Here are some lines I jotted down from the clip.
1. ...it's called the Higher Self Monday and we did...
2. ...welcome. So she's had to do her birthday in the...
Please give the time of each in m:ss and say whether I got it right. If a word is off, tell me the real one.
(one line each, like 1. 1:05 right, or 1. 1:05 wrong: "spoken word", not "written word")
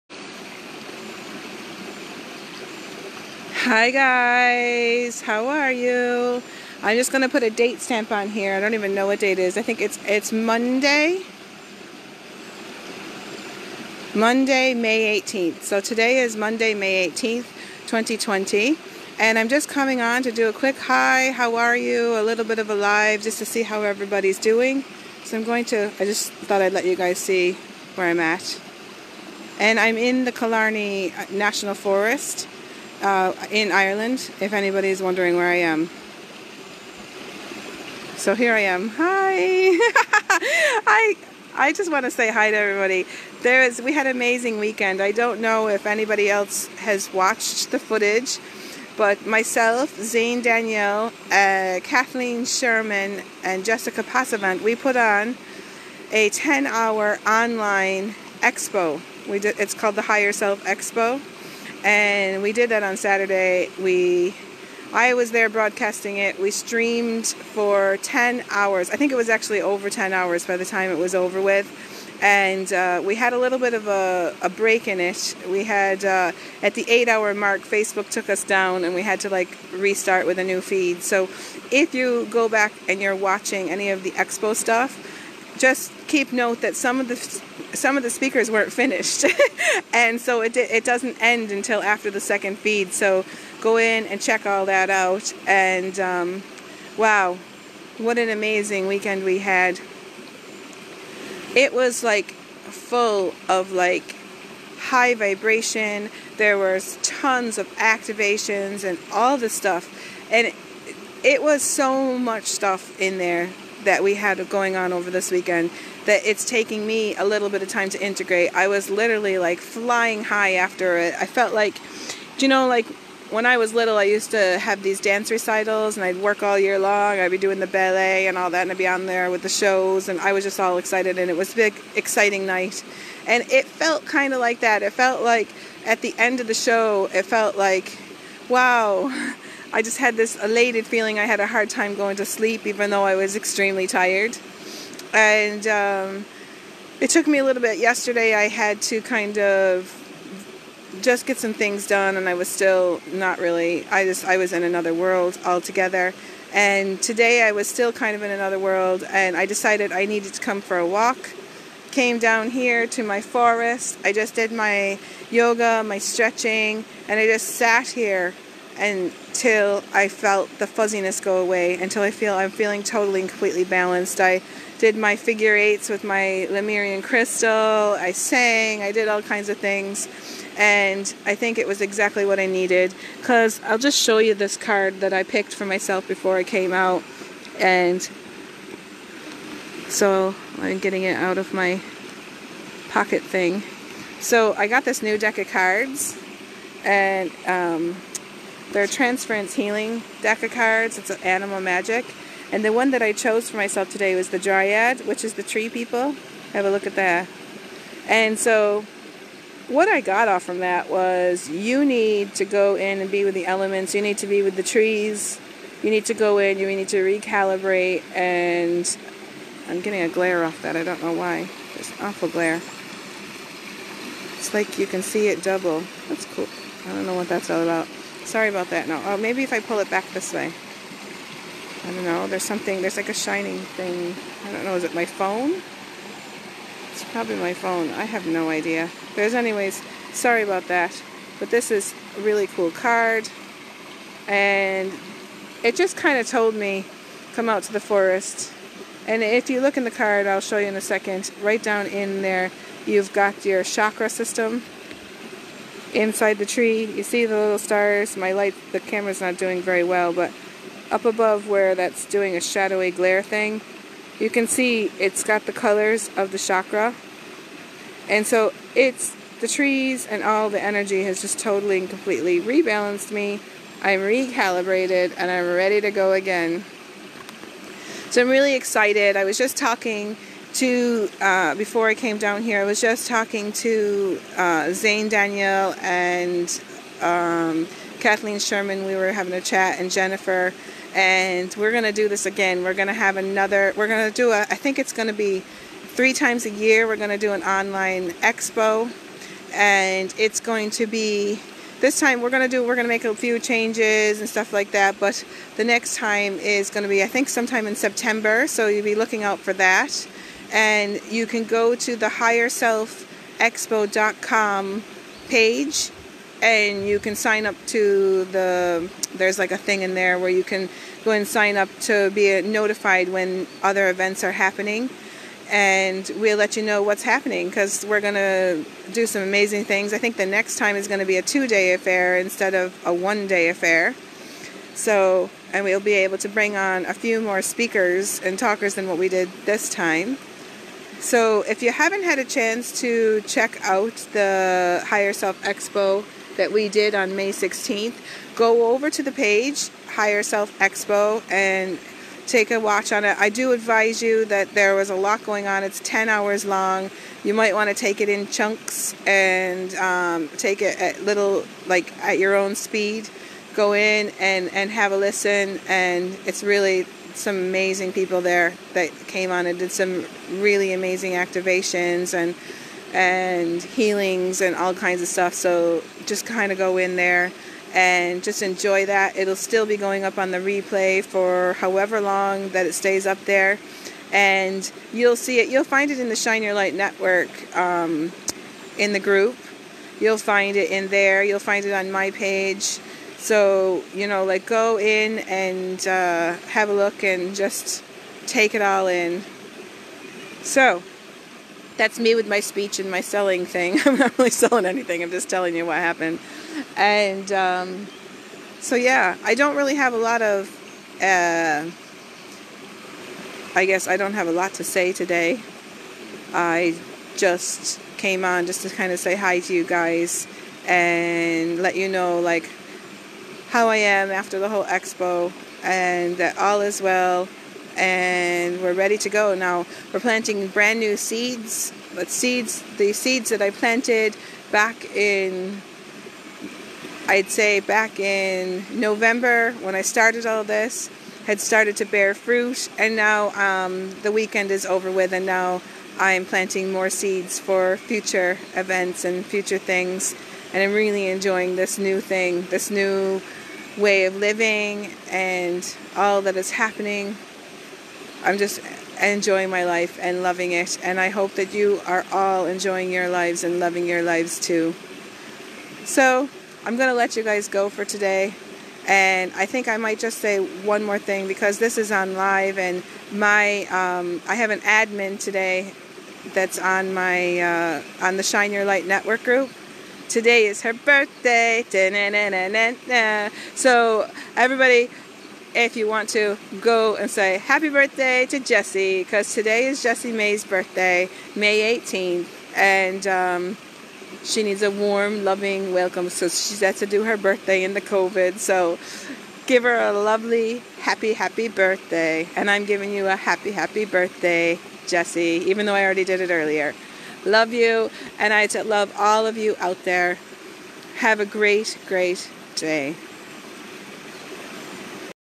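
1. 0:59 wrong: "Expo", not "Monday"
2. 8:15 right.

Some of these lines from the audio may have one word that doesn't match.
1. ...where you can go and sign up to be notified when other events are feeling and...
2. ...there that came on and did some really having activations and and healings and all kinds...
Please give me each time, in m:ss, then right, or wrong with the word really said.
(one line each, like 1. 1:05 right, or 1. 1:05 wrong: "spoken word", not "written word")
1. 5:20 wrong: "happening", not "feeling"
2. 6:08 wrong: "amazing", not "having".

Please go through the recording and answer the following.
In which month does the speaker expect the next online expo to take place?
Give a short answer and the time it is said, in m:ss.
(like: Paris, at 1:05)
September, at 5:07.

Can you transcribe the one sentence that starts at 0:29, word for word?
And I'm in the Killarney uh, National Forest uh, in Ireland, if anybody is wondering where I am.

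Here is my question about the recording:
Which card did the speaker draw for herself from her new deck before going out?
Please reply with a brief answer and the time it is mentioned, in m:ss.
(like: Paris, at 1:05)
the Dryad, at 3:24.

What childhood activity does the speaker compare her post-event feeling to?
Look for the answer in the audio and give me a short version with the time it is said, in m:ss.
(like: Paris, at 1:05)
dance recitals, at 2:04.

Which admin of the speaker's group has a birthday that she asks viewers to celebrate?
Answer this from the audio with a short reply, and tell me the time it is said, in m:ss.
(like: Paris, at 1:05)
Jesse May, at 8:09.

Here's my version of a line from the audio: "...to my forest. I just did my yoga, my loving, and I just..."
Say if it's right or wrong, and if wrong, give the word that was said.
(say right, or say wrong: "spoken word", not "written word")
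wrong: "stretching", not "loving".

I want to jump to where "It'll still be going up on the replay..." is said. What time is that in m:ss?
6:19.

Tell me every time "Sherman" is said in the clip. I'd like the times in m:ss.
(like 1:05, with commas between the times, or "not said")
0:52, 4:48.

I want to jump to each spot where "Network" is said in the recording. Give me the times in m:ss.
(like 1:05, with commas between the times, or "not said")
6:26, 7:58.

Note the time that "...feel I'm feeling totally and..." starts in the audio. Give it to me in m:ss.
2:52.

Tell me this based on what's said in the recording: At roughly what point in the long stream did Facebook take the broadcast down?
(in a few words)
8 hours.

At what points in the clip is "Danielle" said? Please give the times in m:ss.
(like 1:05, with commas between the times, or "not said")
0:50, 4:45.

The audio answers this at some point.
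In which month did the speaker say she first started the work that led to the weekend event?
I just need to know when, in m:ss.
7:18.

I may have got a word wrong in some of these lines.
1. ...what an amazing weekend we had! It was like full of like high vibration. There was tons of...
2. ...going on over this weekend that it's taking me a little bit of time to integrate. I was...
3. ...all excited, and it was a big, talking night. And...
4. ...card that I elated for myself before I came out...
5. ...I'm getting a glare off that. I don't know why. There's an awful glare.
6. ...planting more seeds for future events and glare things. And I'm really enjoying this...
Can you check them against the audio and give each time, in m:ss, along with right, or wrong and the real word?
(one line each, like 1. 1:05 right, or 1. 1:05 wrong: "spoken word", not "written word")
1. 1:37 right
2. 1:54 right
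3. 2:10 wrong: "exciting", not "talking"
4. 3:04 wrong: "picked", not "elated"
5. 3:39 right
6. 7:26 wrong: "future", not "glare".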